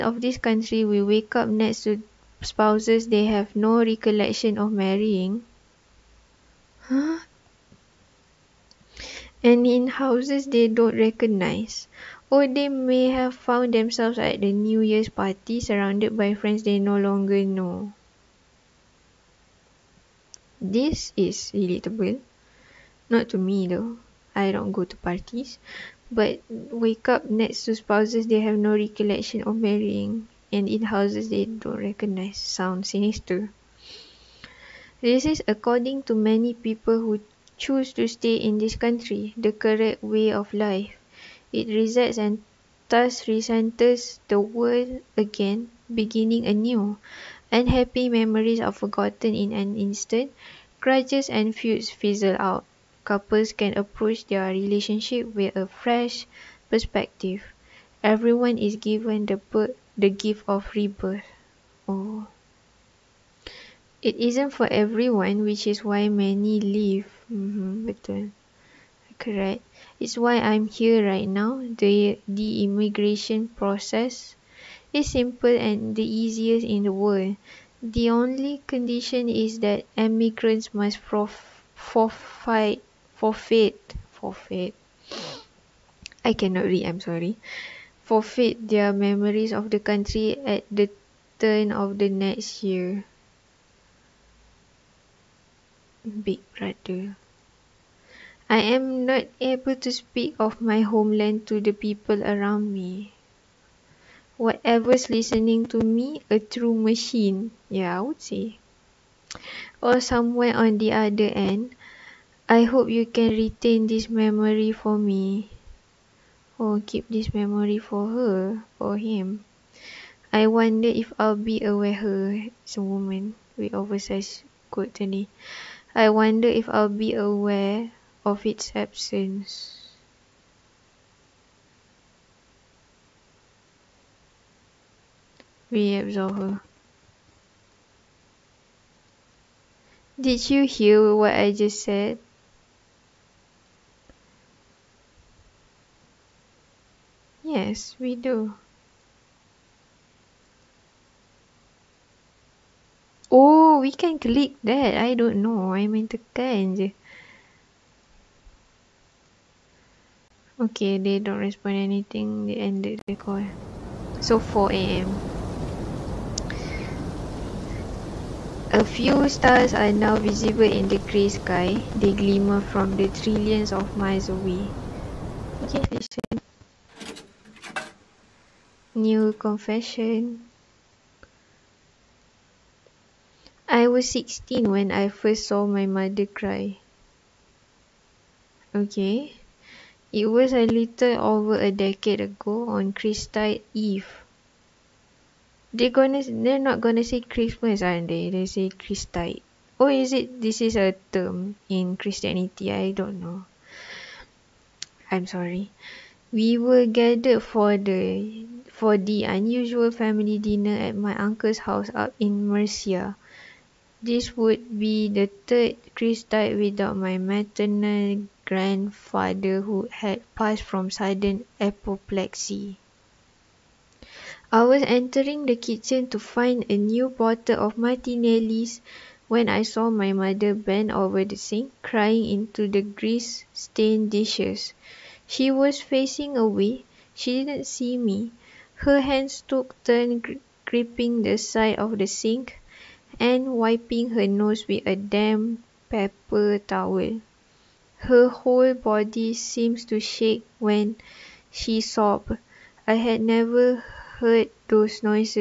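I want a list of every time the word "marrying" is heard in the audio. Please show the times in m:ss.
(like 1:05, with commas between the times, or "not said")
0:04, 0:29.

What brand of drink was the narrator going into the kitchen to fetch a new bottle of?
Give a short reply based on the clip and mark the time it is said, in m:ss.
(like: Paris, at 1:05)
Martinelli's, at 3:47.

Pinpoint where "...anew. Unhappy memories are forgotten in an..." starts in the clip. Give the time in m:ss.
0:46.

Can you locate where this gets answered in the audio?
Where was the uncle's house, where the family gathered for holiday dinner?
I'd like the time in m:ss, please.
3:32.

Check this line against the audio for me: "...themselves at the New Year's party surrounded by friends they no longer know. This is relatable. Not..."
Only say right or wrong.
right.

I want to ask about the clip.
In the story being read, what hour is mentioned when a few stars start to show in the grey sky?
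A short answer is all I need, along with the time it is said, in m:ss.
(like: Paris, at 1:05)
4 a.m., at 2:44.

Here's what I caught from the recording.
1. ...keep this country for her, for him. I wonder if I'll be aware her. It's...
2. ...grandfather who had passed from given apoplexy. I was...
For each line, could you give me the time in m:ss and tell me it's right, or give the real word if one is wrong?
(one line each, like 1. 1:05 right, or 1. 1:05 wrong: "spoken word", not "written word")
1. 1:56 wrong: "memory", not "country"
2. 3:38 wrong: "sudden", not "given".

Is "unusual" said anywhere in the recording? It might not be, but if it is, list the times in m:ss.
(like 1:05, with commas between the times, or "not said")
3:29.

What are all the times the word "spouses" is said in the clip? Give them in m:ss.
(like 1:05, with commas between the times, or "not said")
0:02, 0:27.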